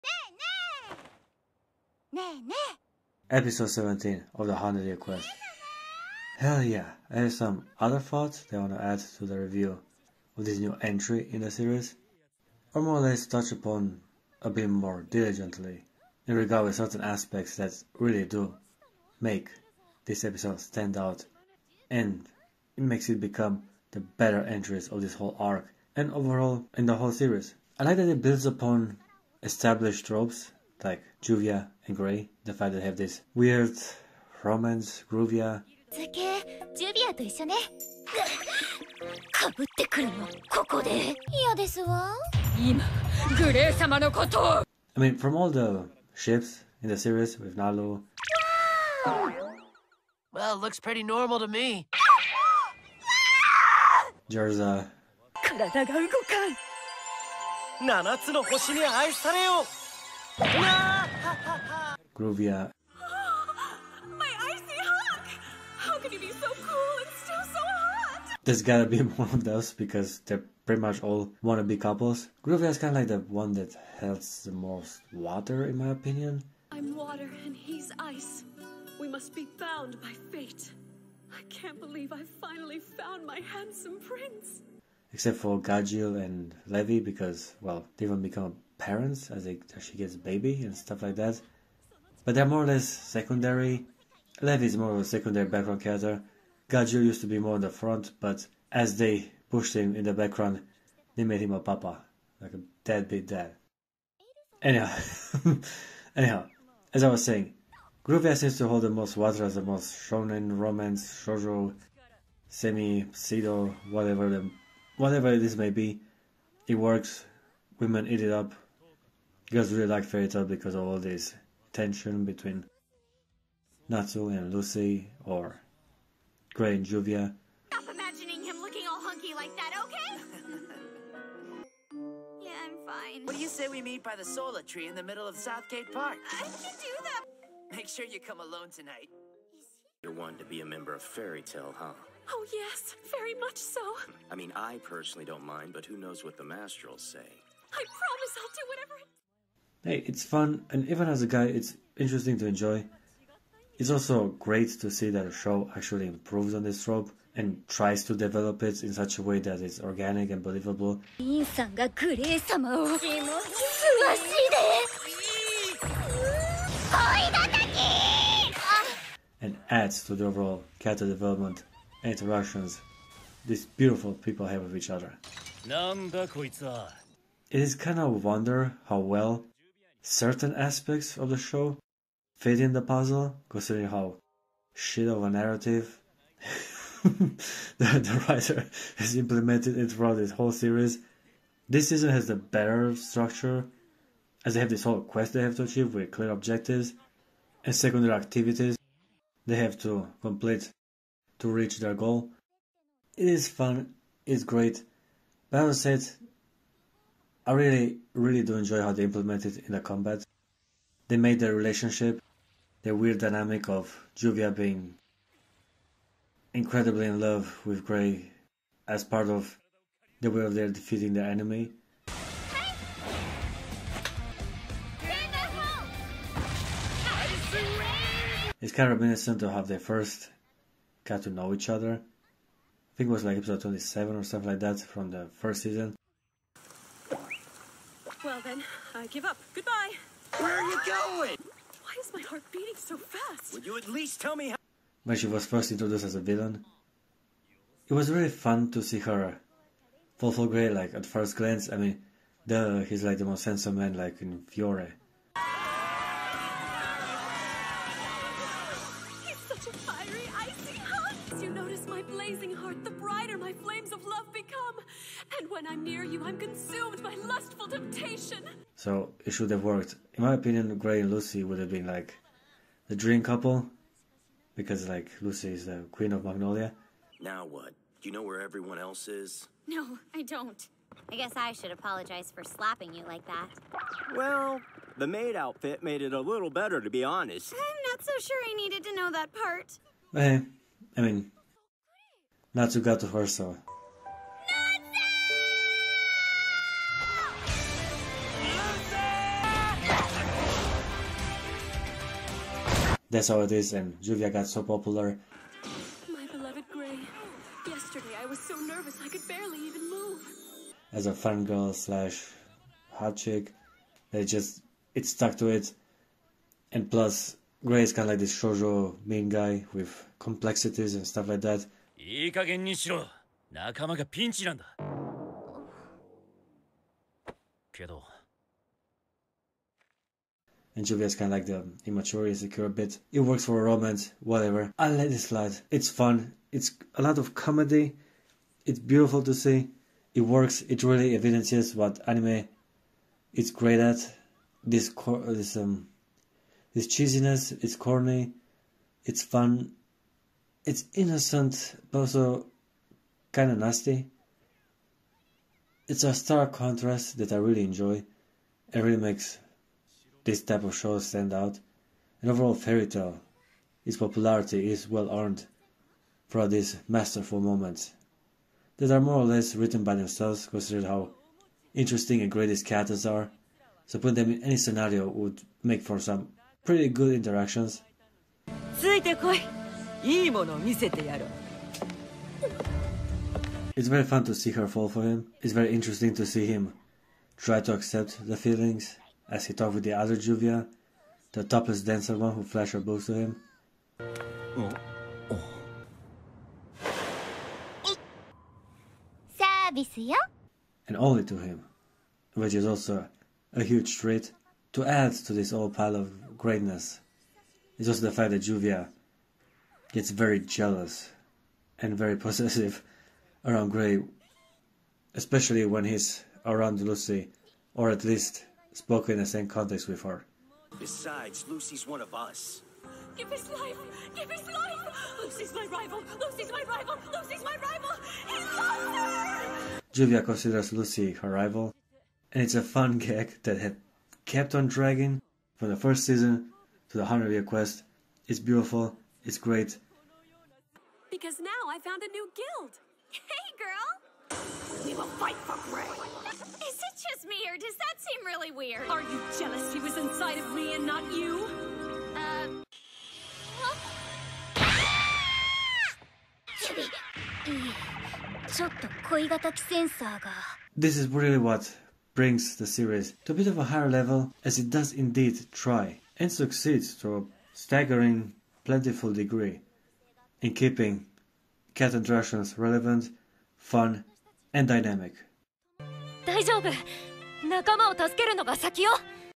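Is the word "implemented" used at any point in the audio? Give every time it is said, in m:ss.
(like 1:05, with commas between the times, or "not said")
3:09, 3:29.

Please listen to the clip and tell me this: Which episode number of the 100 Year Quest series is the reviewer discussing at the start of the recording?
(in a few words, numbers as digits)
17.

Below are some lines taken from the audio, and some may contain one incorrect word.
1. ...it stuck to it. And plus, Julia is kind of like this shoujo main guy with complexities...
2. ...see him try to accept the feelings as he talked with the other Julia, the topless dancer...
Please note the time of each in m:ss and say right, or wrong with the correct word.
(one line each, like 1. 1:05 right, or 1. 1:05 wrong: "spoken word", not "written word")
1. 5:14 wrong: "Gray", not "Julia"
2. 6:26 wrong: "Juvia", not "Julia".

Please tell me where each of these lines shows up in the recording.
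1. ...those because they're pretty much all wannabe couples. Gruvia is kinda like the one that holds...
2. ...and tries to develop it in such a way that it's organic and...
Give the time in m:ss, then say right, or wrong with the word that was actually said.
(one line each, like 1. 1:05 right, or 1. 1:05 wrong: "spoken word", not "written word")
1. 1:09 right
2. 2:37 right.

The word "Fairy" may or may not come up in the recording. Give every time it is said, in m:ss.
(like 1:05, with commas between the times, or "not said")
2:00, 2:21, 6:02.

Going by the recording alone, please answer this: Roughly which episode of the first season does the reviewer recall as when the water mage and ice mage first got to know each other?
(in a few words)
27.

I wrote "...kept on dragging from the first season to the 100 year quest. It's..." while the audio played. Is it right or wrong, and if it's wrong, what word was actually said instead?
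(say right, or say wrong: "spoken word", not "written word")
right.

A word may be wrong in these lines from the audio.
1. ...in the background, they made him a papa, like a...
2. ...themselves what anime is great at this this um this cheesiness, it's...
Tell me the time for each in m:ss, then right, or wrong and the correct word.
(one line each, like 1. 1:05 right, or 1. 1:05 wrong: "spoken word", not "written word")
1. 1:39 right
2. 5:41 wrong: "evidences", not "themselves".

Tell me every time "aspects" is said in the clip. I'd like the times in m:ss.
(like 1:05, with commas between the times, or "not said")
0:16, 3:00.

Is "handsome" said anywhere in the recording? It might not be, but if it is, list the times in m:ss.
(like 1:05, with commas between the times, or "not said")
1:23, 4:13.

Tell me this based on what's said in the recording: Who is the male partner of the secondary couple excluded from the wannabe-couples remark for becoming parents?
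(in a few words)
Gajeel.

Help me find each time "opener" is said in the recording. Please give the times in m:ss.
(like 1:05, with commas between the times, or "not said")
not said.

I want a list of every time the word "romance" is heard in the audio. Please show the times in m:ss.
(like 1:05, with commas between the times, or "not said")
0:34, 1:50, 5:33.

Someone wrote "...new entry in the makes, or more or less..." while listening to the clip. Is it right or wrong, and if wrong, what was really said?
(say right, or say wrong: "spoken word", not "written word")
wrong: "series", not "makes".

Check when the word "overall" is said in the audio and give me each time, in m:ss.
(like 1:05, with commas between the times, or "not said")
0:26, 2:50, 6:02.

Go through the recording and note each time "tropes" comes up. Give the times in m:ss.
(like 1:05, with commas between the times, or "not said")
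0:30, 2:36.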